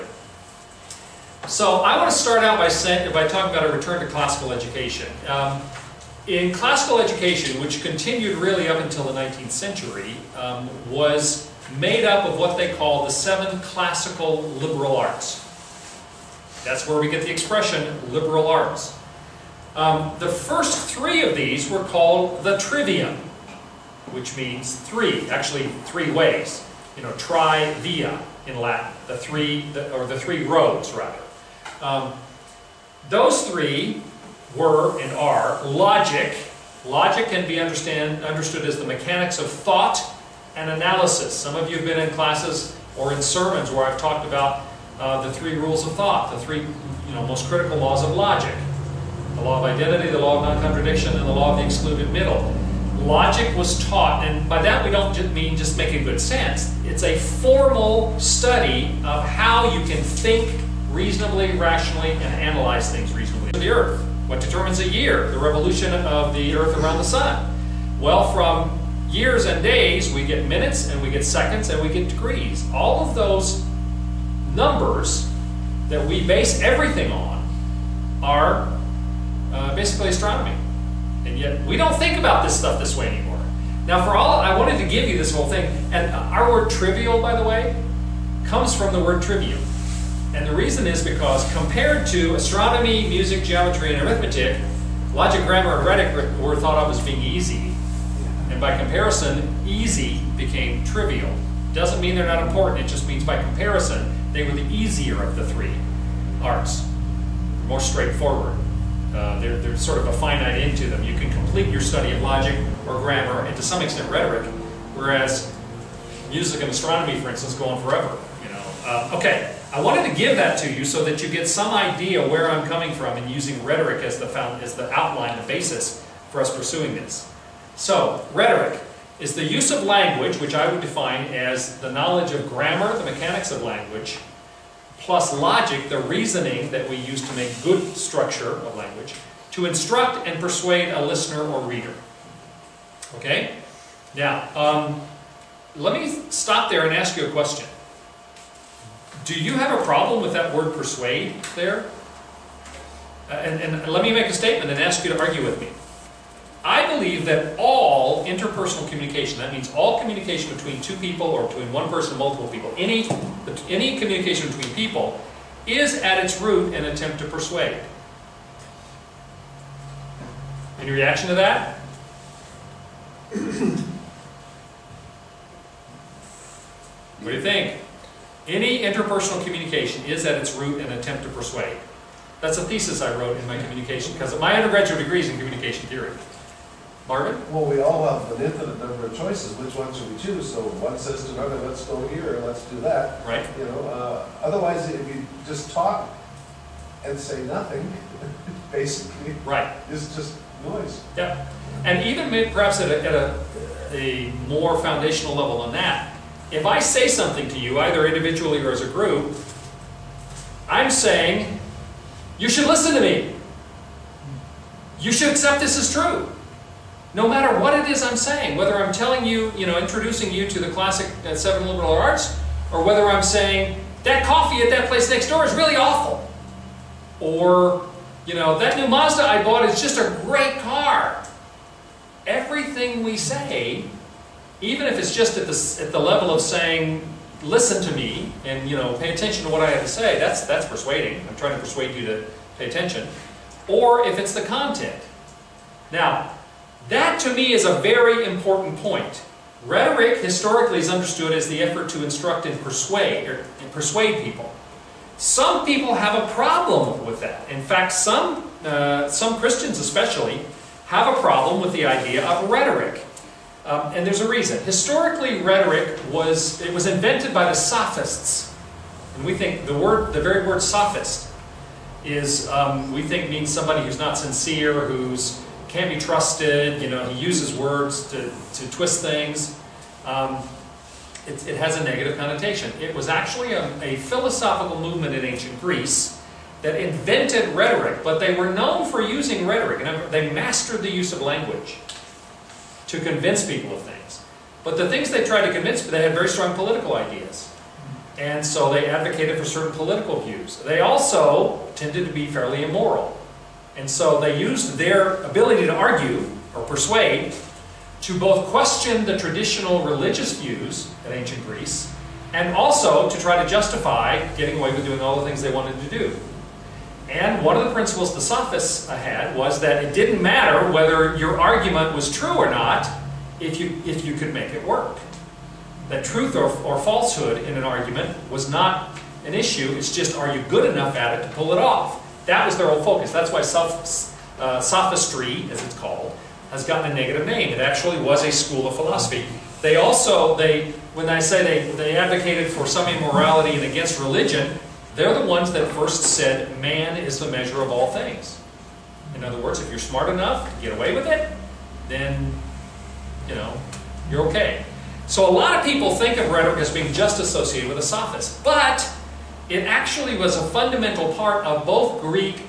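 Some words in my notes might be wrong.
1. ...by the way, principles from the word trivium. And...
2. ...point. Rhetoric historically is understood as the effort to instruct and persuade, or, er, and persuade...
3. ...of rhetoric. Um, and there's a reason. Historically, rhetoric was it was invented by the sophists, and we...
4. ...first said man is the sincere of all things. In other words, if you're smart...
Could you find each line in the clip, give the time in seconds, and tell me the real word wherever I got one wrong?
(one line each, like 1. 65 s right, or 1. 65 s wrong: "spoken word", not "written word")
1. 87 s wrong: "comes", not "principles"
2. 248 s right
3. 262 s right
4. 345 s wrong: "measure", not "sincere".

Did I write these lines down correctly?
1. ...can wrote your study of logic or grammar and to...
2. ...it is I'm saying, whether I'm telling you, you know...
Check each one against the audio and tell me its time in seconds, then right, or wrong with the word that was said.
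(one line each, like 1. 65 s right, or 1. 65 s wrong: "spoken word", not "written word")
1. 111 s wrong: "complete", not "wrote"
2. 217 s right.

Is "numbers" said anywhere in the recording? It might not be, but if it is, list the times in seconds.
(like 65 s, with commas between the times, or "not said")
74 s, 188 s.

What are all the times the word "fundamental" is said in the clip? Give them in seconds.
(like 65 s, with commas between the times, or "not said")
360 s.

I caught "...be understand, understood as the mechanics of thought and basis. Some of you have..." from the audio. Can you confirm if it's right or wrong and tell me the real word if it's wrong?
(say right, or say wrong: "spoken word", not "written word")
wrong: "analysis", not "basis".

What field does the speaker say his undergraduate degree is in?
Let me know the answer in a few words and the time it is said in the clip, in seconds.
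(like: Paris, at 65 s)
communication theory, at 185 s.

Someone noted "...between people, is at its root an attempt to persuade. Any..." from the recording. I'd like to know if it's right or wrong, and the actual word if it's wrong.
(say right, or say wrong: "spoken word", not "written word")
right.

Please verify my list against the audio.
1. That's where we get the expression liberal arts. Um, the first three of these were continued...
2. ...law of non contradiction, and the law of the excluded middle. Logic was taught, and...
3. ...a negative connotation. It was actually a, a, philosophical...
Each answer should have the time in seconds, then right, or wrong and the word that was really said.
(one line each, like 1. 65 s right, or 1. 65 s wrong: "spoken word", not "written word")
1. 16 s wrong: "called", not "continued"
2. 50 s right
3. 281 s right.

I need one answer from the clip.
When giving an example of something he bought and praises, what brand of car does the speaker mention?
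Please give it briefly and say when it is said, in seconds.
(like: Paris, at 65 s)
Mazda, at 228 s.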